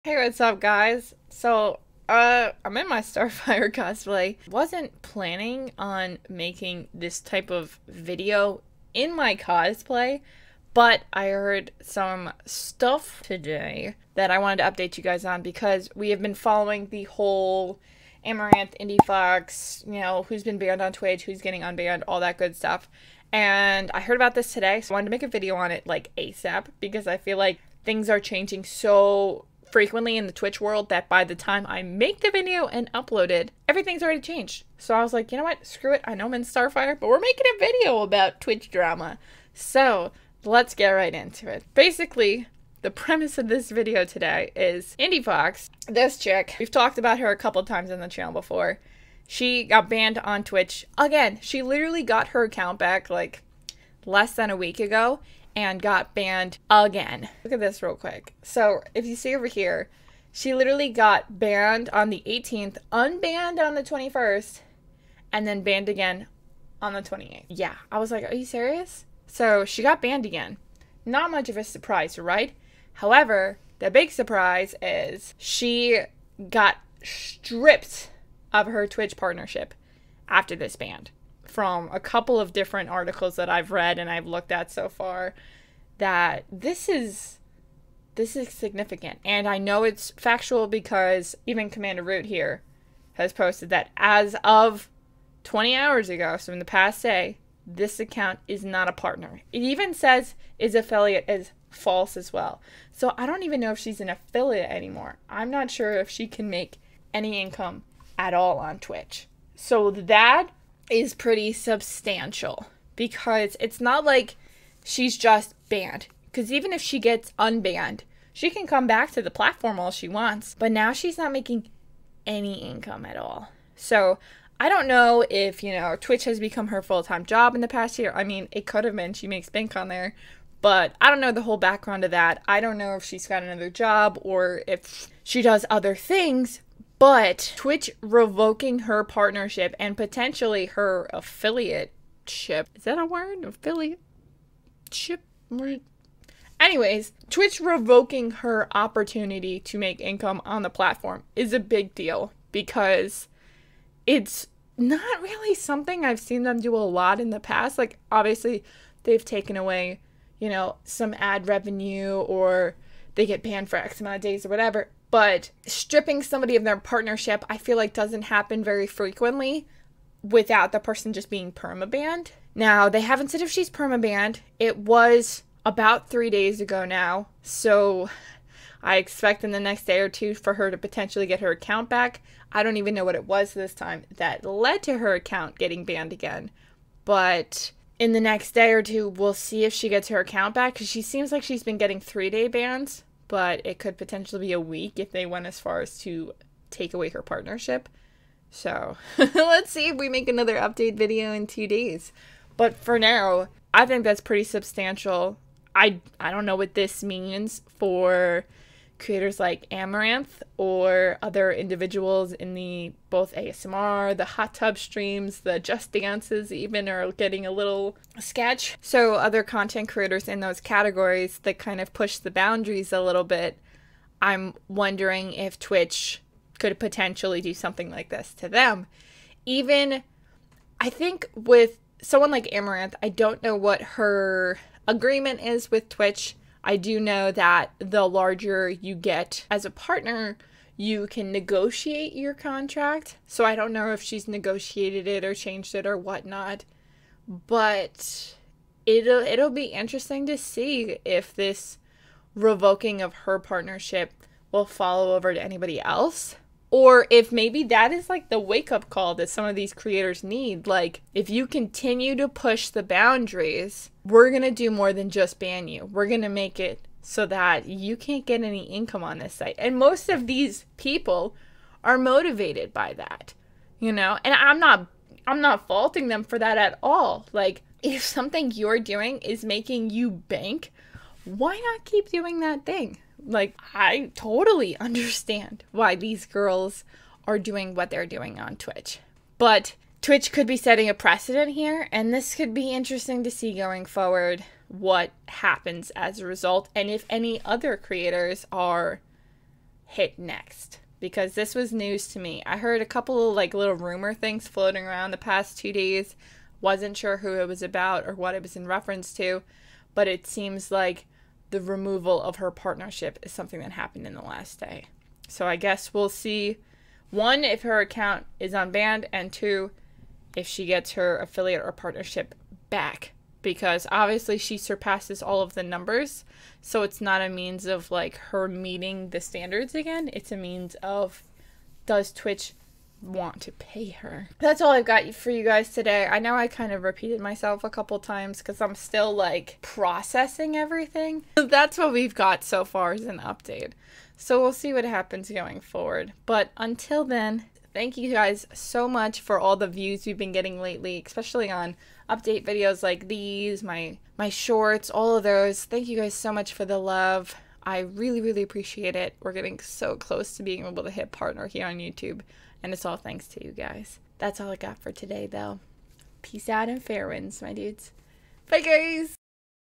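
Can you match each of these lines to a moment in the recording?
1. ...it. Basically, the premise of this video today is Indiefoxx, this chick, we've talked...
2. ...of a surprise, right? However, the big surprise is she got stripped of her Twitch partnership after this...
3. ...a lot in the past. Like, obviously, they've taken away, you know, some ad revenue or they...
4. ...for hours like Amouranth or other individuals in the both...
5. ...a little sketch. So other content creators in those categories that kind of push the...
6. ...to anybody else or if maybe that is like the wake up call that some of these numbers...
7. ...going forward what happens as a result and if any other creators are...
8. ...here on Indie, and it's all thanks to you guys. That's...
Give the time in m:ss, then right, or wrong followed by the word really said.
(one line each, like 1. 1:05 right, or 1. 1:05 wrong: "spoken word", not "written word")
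1. 0:41 right
2. 1:11 right
3. 2:36 right
4. 3:27 wrong: "creators", not "hours"
5. 3:37 right
6. 4:15 wrong: "creators", not "numbers"
7. 4:53 right
8. 6:01 wrong: "YouTube", not "Indie".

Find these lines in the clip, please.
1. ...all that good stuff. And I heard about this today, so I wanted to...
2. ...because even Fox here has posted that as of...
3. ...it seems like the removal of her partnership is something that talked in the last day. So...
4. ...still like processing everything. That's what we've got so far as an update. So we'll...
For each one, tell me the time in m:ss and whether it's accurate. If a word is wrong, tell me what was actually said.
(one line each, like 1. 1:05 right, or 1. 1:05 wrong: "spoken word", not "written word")
1. 0:22 right
2. 1:30 wrong: "CommanderRoot", not "Fox"
3. 5:10 wrong: "happened", not "talked"
4. 5:38 right.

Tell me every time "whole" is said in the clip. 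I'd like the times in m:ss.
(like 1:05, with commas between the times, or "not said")
0:17, 2:11.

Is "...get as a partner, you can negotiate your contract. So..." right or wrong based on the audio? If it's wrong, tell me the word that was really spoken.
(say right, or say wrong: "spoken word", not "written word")
right.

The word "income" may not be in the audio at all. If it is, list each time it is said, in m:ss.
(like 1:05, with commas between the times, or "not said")
1:47, 2:02, 2:29, 4:28.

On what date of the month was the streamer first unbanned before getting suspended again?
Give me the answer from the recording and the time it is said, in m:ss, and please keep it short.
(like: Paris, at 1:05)
21st, at 1:02.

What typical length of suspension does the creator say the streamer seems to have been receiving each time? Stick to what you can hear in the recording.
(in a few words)
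3 days.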